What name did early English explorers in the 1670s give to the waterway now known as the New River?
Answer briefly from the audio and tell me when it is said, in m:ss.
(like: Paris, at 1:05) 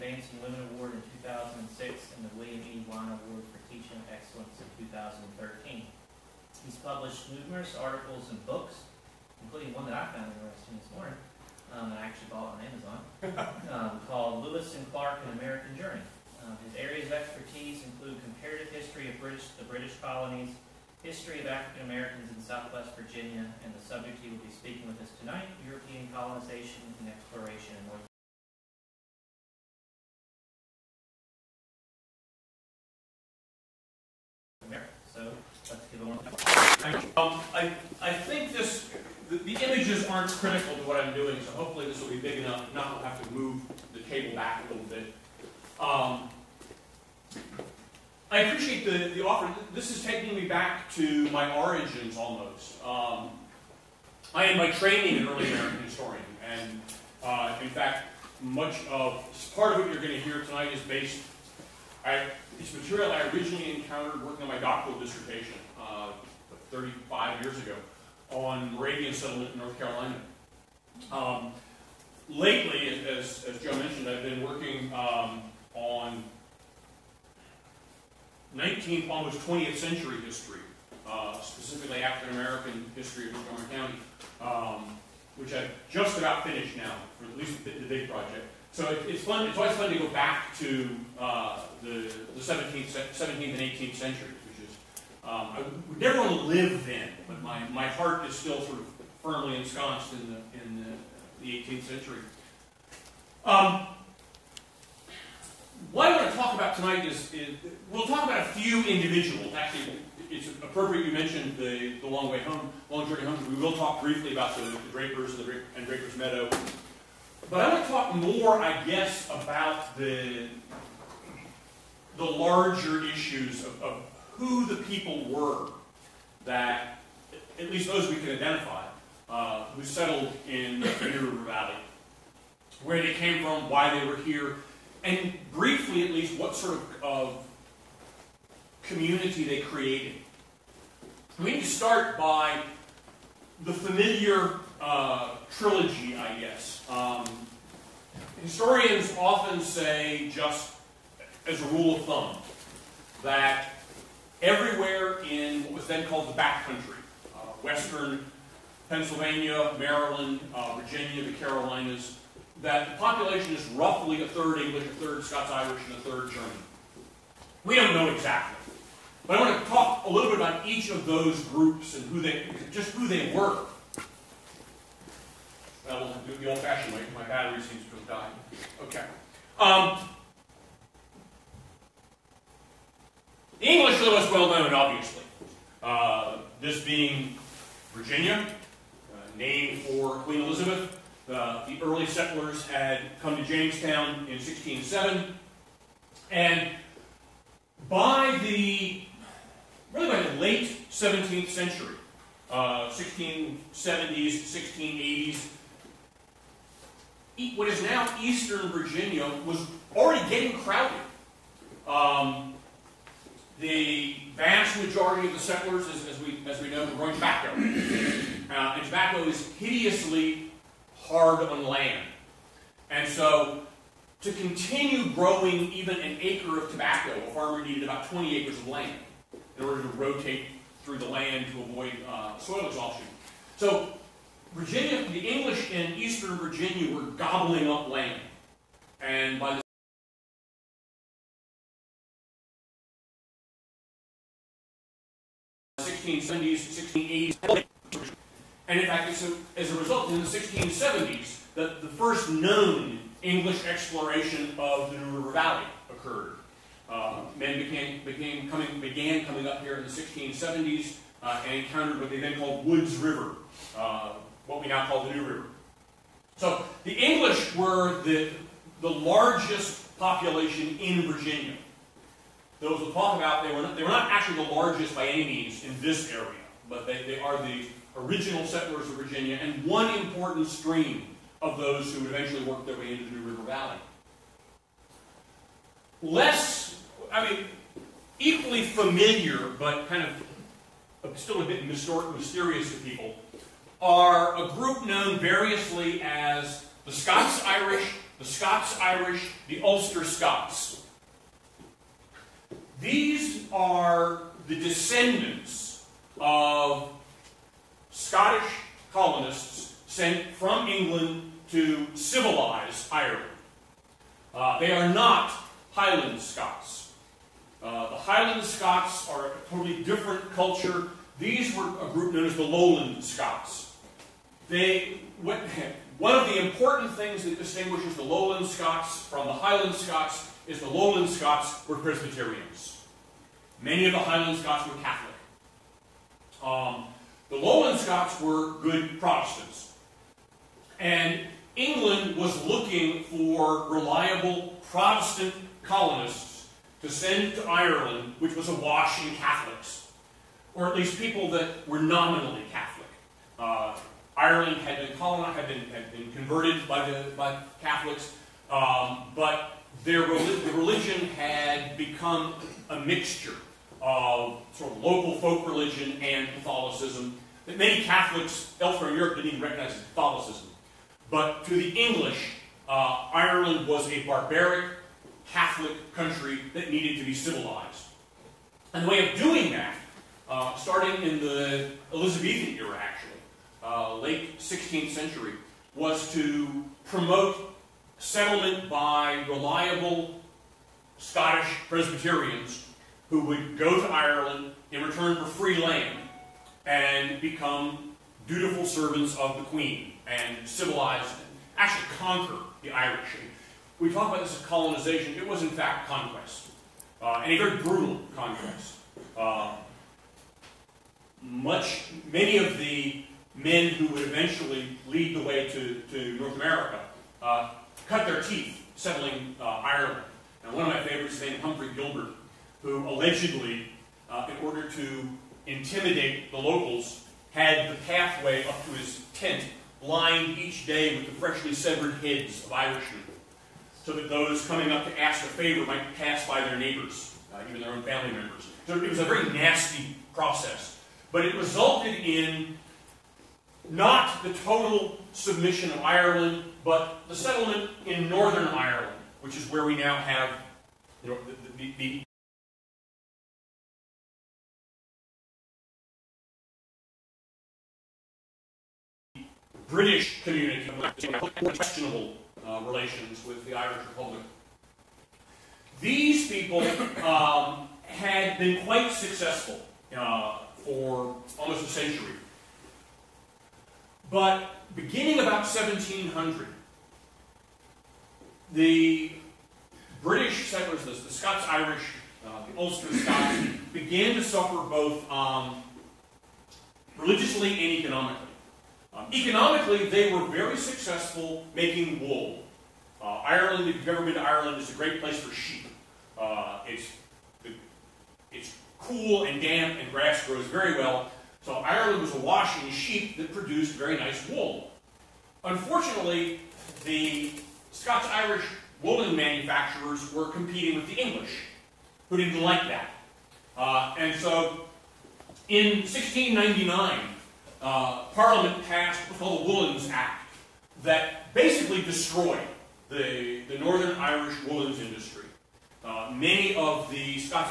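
Woods River, at 4:22.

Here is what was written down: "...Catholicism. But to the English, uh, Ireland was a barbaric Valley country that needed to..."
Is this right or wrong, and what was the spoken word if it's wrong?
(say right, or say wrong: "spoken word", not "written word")
wrong: "Catholic", not "Valley".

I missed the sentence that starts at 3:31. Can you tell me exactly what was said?
Um, the vast majority of the settlers, as, as, we, as we know, were growing tobacco.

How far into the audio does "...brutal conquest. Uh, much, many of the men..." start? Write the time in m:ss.
6:47.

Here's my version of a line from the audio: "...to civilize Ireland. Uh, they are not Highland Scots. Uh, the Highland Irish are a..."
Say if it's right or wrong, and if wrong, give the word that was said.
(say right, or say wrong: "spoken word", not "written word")
wrong: "Scots", not "Irish".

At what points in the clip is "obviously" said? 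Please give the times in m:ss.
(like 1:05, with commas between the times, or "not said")
3:04.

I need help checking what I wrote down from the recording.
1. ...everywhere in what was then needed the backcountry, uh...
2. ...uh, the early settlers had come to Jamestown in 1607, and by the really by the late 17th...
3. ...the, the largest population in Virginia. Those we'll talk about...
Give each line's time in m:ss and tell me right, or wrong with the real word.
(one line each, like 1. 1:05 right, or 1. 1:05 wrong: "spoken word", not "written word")
1. 2:34 wrong: "called", not "needed"
2. 3:11 right
3. 4:28 right.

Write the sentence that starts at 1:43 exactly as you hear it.
Um, what I want to talk about tonight is, is we'll talk about a few individuals.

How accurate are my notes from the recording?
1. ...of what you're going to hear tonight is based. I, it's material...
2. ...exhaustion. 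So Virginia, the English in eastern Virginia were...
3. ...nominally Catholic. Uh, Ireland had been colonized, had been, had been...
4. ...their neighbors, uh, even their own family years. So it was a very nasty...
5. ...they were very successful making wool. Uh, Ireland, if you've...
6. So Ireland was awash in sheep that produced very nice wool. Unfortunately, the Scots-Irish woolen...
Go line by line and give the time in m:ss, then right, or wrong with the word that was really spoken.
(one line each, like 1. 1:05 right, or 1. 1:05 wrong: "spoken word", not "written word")
1. 0:59 right
2. 3:52 right
3. 5:51 right
4. 7:16 wrong: "members", not "years"
5. 8:09 right
6. 8:21 right.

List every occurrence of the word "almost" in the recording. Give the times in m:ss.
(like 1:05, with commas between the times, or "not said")
0:52, 1:19, 7:51.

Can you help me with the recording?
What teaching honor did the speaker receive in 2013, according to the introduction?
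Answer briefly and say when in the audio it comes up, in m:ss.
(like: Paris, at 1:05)
William E. Wine Award, at 0:02.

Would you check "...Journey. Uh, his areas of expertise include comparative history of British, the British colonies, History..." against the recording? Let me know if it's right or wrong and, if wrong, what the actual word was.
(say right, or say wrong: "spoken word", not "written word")
right.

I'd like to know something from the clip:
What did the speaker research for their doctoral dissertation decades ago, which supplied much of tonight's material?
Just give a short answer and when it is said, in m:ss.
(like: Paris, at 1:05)
Moravian settlement in North Carolina, at 1:08.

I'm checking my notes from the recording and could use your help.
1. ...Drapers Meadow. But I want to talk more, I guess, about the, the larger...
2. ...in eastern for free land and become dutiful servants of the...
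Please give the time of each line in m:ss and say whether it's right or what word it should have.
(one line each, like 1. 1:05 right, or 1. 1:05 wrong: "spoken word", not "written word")
1. 1:55 right
2. 6:34 wrong: "return", not "eastern".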